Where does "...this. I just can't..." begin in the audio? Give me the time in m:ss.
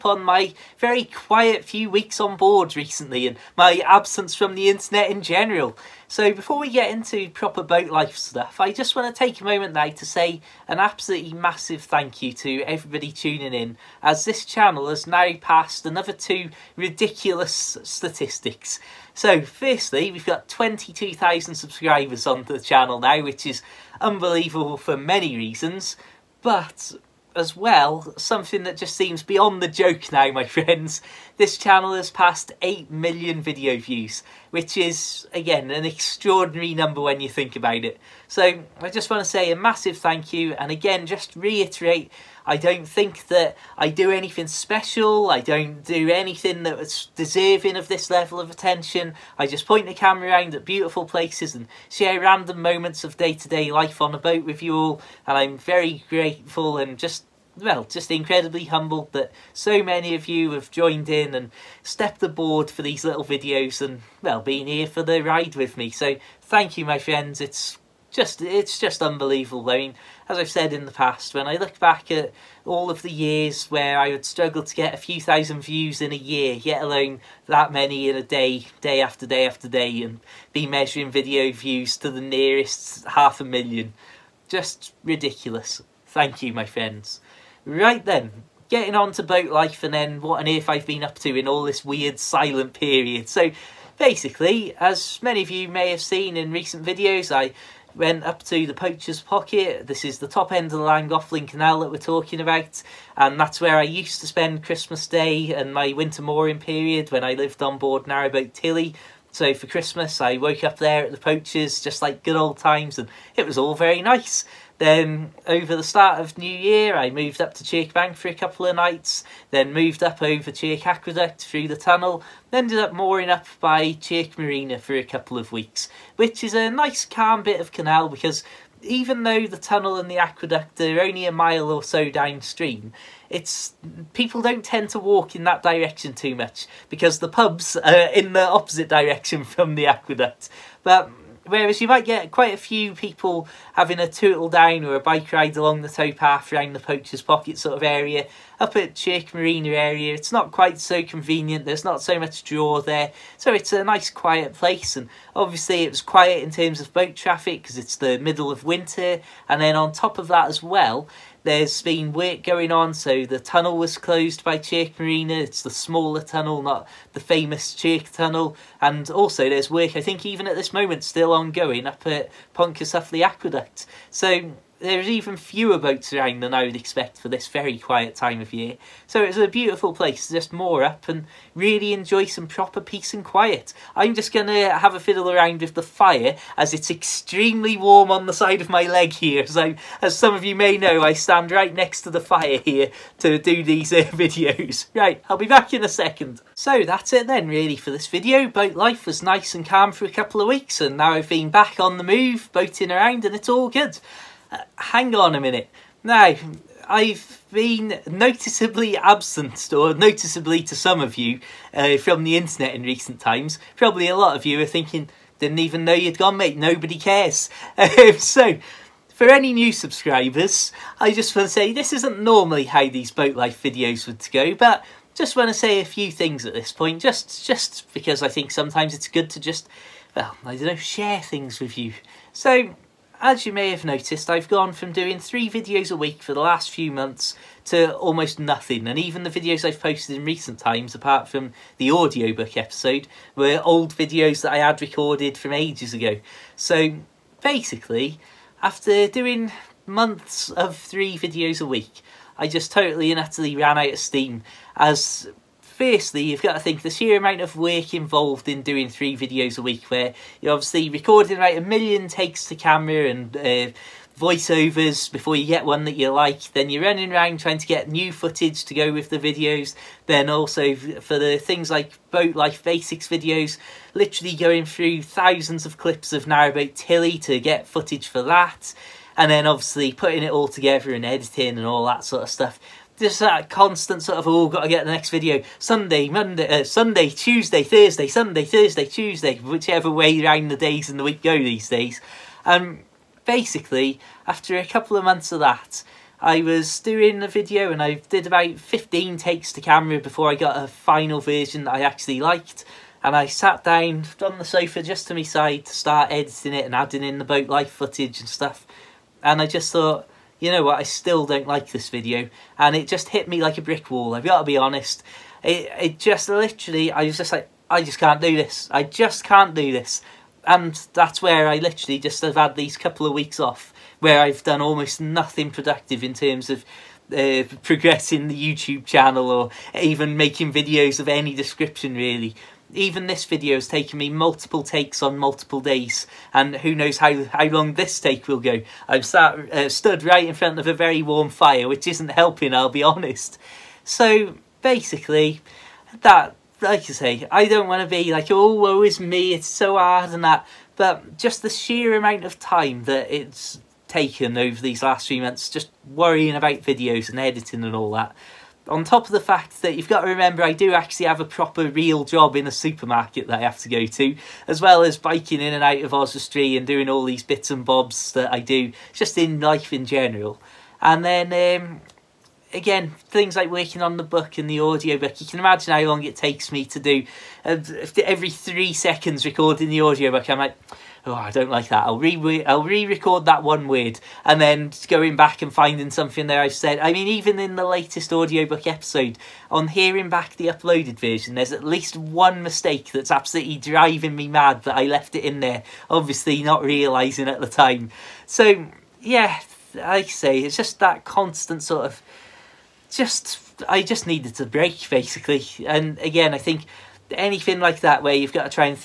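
5:18.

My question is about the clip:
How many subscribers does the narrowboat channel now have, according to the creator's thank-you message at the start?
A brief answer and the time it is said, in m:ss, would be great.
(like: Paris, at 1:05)
22,000, at 0:20.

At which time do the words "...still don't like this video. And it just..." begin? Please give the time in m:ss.
5:10.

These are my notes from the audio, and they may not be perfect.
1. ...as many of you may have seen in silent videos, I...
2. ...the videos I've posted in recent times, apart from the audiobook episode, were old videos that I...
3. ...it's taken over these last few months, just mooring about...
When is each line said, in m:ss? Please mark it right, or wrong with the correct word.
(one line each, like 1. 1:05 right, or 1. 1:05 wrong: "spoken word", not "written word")
1. 1:34 wrong: "recent", not "silent"
2. 3:59 right
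3. 5:53 wrong: "worrying", not "mooring".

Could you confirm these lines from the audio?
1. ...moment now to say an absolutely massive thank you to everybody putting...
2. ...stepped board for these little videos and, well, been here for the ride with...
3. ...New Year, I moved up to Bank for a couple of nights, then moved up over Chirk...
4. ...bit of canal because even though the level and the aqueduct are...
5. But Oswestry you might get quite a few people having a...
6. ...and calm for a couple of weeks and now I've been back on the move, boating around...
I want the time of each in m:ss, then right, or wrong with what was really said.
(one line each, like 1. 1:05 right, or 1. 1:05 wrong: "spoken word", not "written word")
1. 0:09 wrong: "tuning", not "putting"
2. 1:01 wrong: "aboard", not "board"
3. 1:56 right
4. 2:07 wrong: "tunnel", not "level"
5. 2:20 wrong: "Whereas", not "Oswestry"
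6. 3:19 right.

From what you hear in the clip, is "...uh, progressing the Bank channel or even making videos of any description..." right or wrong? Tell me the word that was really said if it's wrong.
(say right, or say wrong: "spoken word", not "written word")
wrong: "YouTube", not "Bank".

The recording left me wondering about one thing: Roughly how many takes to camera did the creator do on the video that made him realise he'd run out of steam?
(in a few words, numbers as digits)
15.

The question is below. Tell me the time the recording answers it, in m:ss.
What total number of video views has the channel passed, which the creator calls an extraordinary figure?
0:32.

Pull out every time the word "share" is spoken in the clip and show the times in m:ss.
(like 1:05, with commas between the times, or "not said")
0:51, 3:50.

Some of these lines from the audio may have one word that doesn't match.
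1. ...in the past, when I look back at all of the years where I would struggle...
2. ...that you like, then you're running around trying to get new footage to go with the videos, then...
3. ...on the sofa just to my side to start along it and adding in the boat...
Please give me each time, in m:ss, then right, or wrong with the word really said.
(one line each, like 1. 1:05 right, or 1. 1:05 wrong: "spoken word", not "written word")
1. 1:10 right
2. 4:25 right
3. 5:04 wrong: "editing", not "along".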